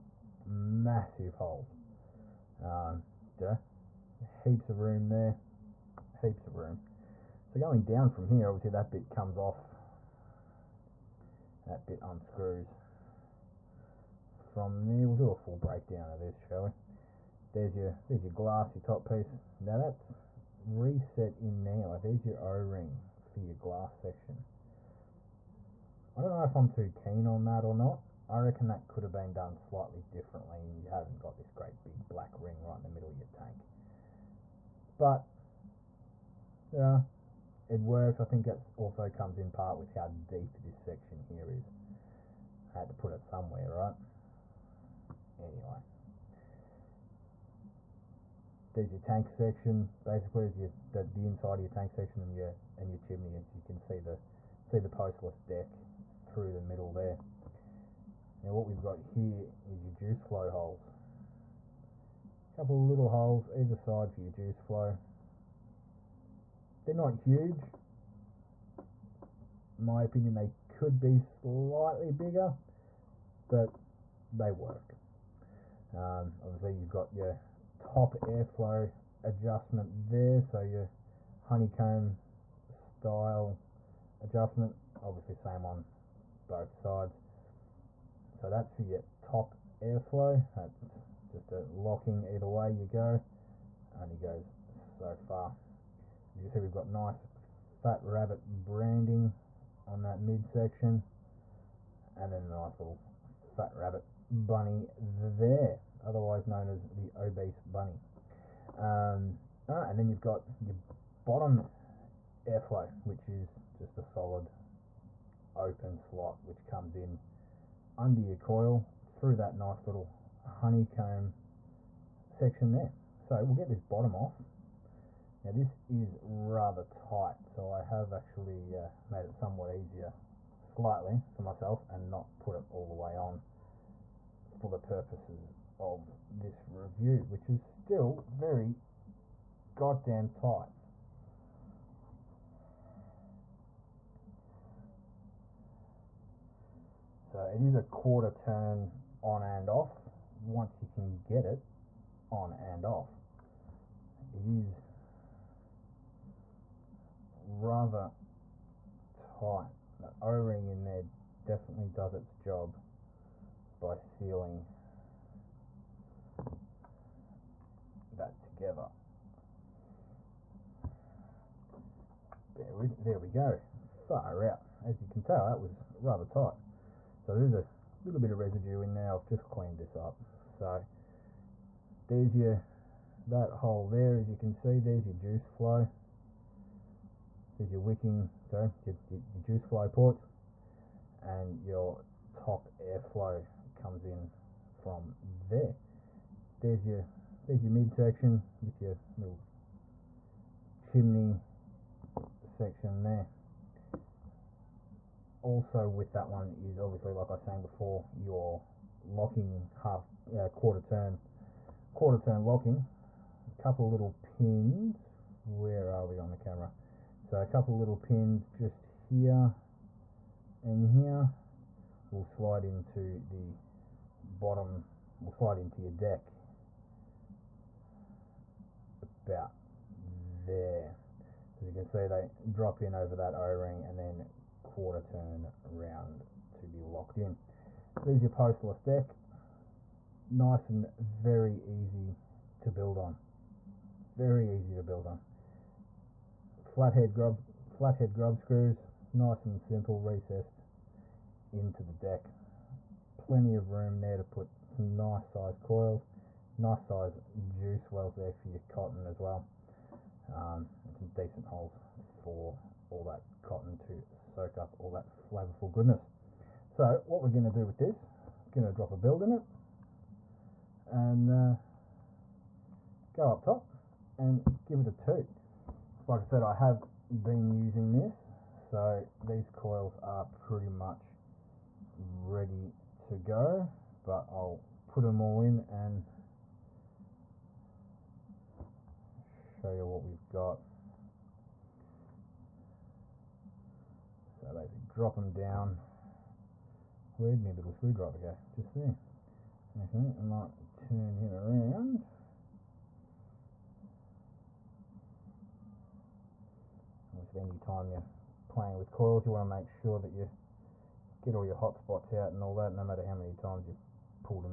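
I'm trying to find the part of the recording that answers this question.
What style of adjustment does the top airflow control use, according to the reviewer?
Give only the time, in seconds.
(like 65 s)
81 s.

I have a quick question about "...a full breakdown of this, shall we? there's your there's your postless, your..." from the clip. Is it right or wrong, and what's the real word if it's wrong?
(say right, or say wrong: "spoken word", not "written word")
wrong: "glass", not "postless".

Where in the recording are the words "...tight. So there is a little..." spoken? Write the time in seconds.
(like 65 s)
176 s.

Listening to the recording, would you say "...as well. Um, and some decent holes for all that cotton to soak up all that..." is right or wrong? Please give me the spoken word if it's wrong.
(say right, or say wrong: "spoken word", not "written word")
right.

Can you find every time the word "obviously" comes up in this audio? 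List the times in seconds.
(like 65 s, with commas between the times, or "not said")
8 s, 76 s, 85 s, 206 s, 307 s.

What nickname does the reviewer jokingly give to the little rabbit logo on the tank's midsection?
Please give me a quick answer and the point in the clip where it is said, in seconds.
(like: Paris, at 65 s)
the obese bunny, at 106 s.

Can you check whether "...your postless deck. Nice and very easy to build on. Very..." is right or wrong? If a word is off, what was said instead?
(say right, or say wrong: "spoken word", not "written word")
right.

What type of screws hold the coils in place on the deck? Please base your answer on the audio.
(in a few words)
flathead grub screws.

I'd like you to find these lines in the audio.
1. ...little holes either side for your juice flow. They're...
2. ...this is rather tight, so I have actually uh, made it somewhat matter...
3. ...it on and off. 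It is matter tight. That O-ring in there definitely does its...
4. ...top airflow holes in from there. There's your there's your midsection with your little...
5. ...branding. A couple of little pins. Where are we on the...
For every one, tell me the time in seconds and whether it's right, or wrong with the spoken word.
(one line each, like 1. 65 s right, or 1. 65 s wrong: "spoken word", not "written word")
1. 62 s right
2. 125 s wrong: "easier", not "matter"
3. 151 s wrong: "rather", not "matter"
4. 192 s wrong: "comes", not "holes"
5. 212 s wrong: "locking", not "branding".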